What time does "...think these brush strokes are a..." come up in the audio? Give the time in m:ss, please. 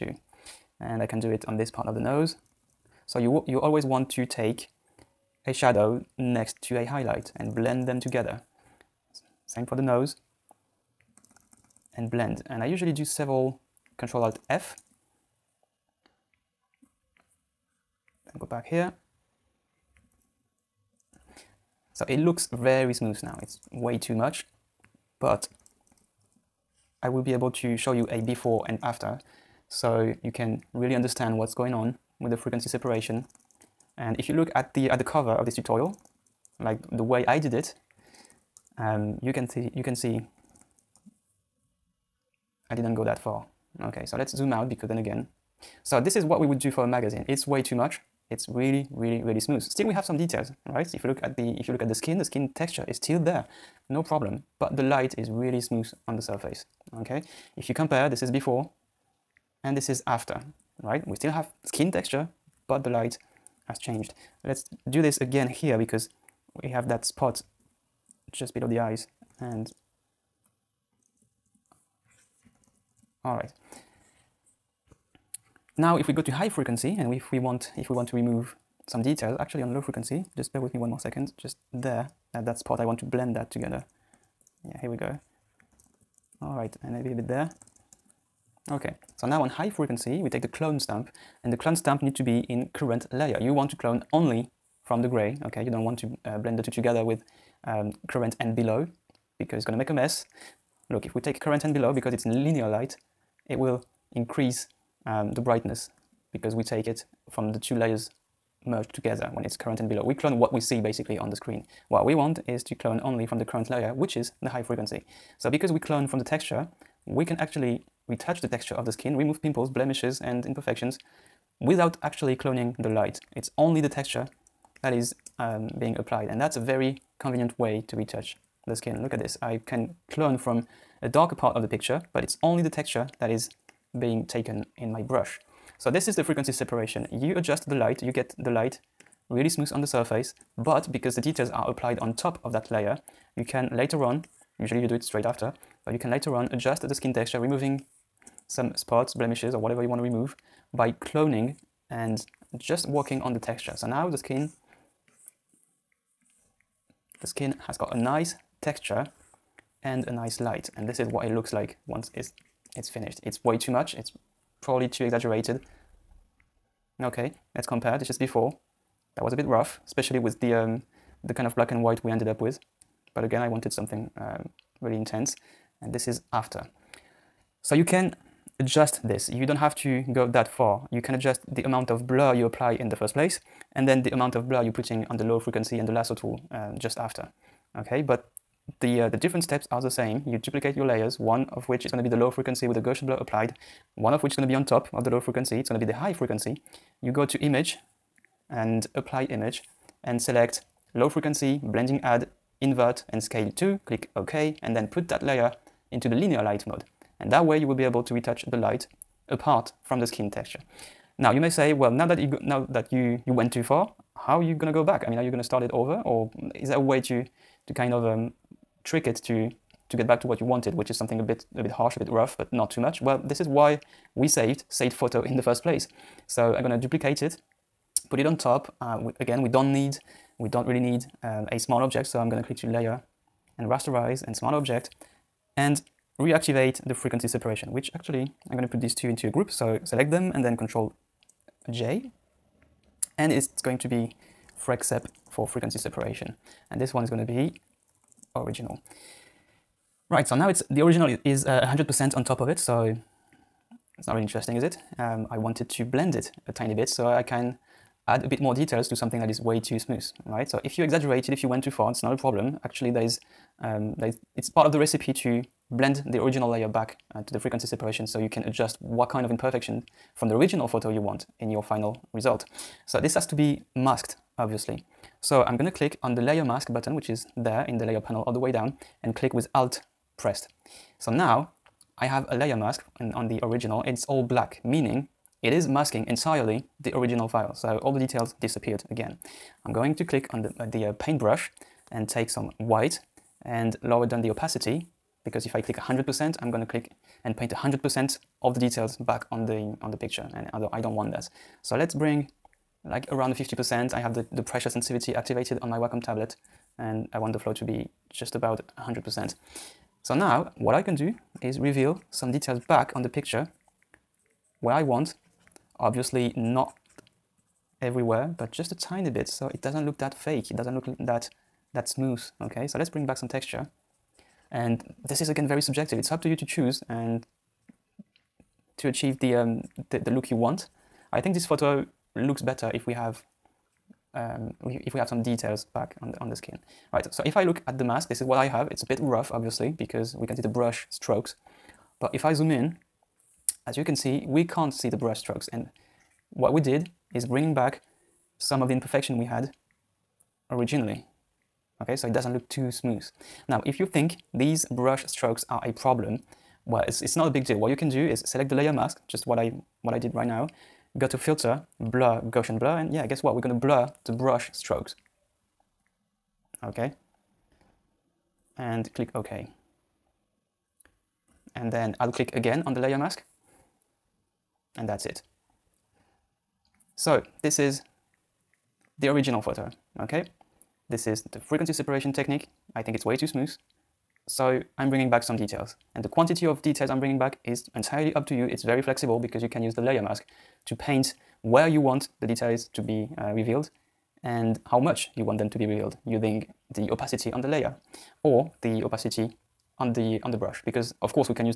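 5:53.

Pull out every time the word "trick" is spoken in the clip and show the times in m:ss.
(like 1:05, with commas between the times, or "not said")
3:38.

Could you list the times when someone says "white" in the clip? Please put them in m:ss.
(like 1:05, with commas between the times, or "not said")
2:51, 4:52.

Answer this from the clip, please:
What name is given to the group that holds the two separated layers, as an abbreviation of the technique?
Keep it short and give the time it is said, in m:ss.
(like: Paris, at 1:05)
freq sep, at 4:04.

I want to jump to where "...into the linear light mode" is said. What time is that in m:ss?
3:25.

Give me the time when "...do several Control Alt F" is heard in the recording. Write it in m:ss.
0:12.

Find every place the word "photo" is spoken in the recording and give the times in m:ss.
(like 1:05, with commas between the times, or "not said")
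3:44, 4:30, 5:31, 6:19.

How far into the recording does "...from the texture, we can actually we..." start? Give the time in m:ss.
1:56.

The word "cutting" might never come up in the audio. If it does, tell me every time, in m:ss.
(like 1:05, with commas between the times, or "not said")
not said.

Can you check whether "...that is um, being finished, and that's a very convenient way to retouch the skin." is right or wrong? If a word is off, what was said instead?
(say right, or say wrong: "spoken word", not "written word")
wrong: "applied", not "finished".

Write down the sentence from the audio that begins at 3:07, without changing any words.
Okay, but the, uh, the different steps are the same.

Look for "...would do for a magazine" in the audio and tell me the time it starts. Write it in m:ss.
0:46.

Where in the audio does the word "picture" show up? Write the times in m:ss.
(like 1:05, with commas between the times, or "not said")
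2:11, 4:59, 5:13.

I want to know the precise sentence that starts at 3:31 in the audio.
Now you may say, well, now that you now that you you went too far, how are you gonna go back?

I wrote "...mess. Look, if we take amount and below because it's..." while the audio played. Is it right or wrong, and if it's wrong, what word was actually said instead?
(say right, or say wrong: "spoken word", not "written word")
wrong: "current", not "amount".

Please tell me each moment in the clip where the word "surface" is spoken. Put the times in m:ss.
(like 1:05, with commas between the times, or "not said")
0:56, 2:19.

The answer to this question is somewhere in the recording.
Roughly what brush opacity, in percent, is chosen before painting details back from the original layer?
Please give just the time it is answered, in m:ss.
5:03.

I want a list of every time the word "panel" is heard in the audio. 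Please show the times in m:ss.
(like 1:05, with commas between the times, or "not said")
4:37.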